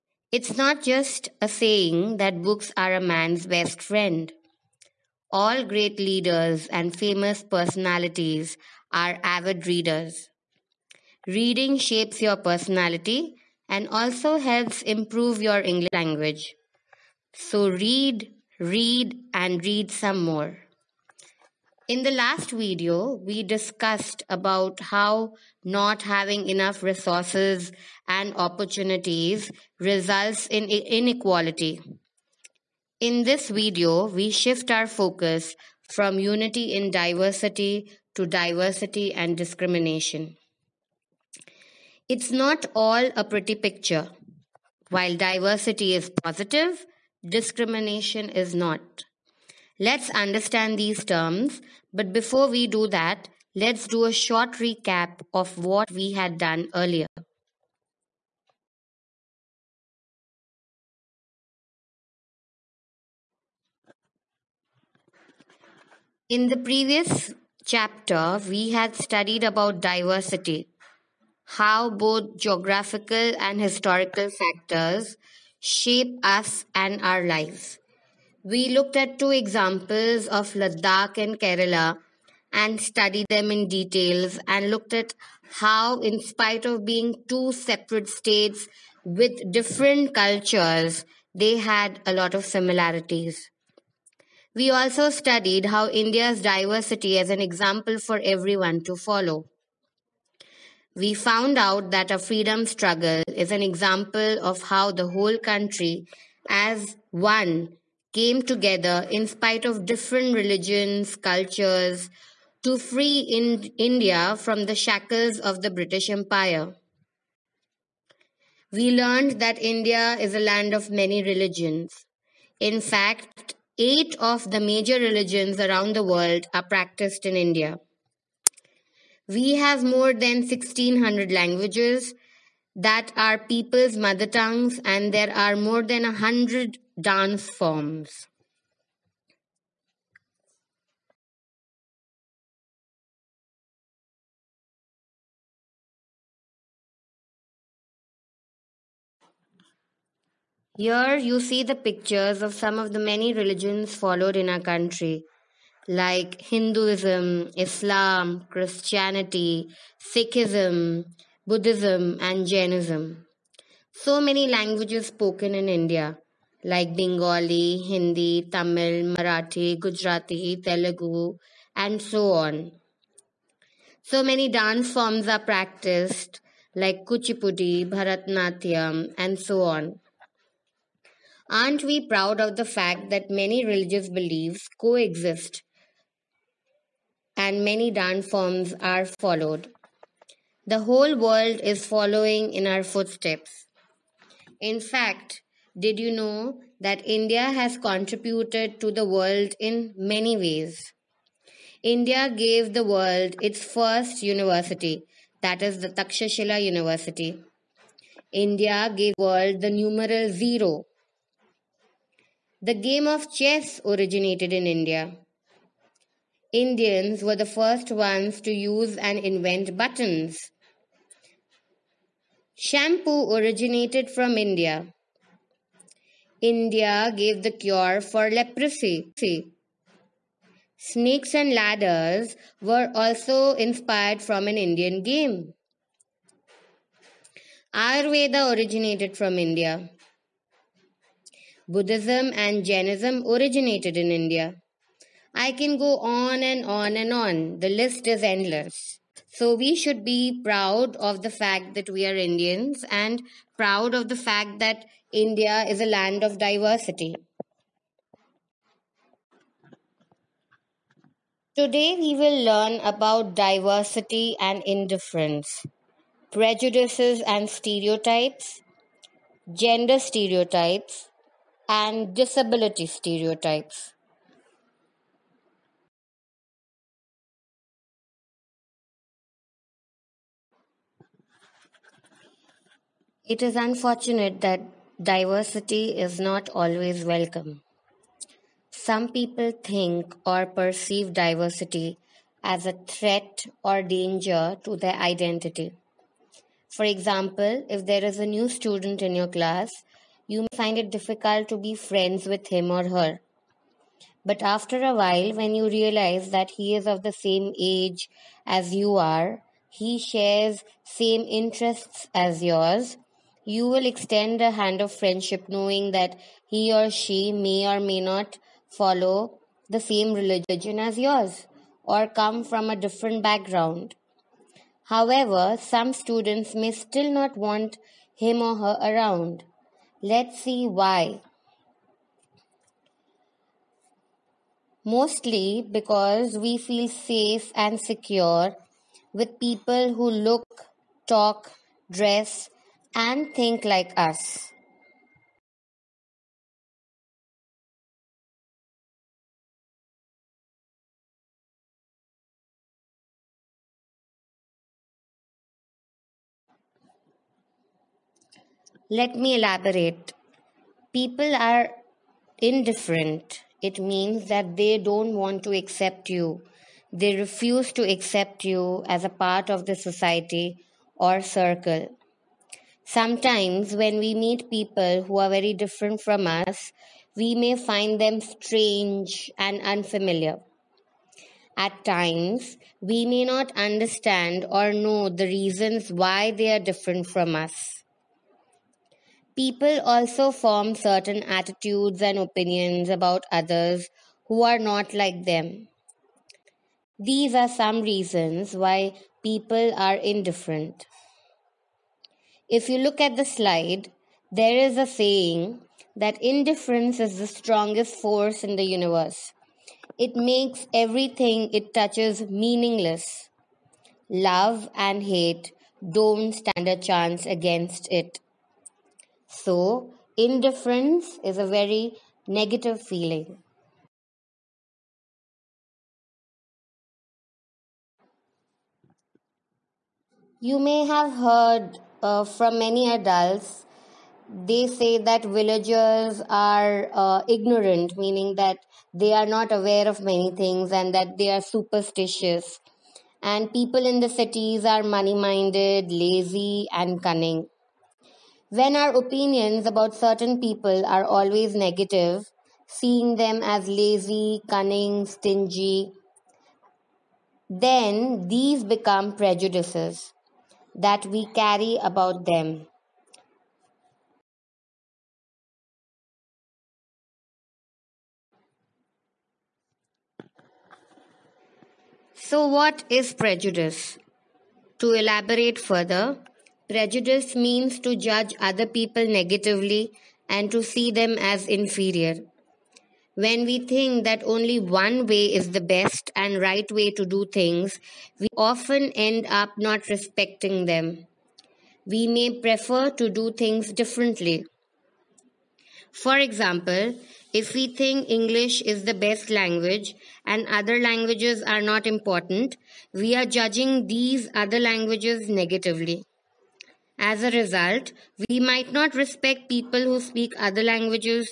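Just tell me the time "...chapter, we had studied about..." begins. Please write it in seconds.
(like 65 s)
67 s.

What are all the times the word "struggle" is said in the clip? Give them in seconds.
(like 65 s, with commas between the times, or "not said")
102 s.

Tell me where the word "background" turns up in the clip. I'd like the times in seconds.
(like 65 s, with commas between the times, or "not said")
323 s.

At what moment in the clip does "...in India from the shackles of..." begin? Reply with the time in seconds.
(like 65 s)
113 s.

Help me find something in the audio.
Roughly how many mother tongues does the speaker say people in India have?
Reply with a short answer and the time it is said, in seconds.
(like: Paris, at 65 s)
more than 1600, at 129 s.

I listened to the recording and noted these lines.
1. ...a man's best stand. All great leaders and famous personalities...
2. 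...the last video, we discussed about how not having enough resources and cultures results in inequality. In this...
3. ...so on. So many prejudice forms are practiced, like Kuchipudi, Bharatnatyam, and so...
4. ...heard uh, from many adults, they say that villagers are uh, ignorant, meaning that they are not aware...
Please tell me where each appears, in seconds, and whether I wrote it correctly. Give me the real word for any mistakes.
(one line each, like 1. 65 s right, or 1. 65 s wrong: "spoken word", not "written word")
1. 2 s wrong: "friend", not "stand"
2. 22 s wrong: "opportunities", not "cultures"
3. 172 s wrong: "dance", not "prejudice"
4. 431 s right.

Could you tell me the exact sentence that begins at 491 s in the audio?
We may prefer to do things differently.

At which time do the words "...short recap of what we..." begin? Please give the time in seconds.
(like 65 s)
54 s.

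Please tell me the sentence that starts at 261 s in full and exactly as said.
Today we will learn about diversity and indifference, prejudices and stereotypes, gender stereotypes, and disability stereotypes.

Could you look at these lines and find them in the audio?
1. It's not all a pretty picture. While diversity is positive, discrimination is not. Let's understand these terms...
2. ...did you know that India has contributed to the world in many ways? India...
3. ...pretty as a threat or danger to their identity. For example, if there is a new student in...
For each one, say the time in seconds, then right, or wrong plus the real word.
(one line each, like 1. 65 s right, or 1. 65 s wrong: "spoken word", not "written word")
1. 42 s right
2. 195 s right
3. 291 s wrong: "diversity", not "pretty".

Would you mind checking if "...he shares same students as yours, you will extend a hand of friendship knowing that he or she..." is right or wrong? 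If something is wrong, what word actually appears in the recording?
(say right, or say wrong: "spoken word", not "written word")
wrong: "interests", not "students".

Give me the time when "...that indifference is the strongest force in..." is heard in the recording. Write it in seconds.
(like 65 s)
405 s.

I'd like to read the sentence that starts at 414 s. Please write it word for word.
Love and hate don't stand a chance against it.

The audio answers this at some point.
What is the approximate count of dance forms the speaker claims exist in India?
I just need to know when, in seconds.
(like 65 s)
135 s.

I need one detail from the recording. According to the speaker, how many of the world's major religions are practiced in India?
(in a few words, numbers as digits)
8.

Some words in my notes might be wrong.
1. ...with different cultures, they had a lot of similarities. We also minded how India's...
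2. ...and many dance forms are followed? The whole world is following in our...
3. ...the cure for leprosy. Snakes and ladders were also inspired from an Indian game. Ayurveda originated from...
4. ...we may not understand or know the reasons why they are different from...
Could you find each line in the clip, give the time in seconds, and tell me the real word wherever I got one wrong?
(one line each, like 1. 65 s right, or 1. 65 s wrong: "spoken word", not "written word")
1. 89 s wrong: "studied", not "minded"
2. 187 s right
3. 227 s right
4. 382 s right.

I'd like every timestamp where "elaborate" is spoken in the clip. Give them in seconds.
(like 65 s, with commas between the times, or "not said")
359 s, 474 s.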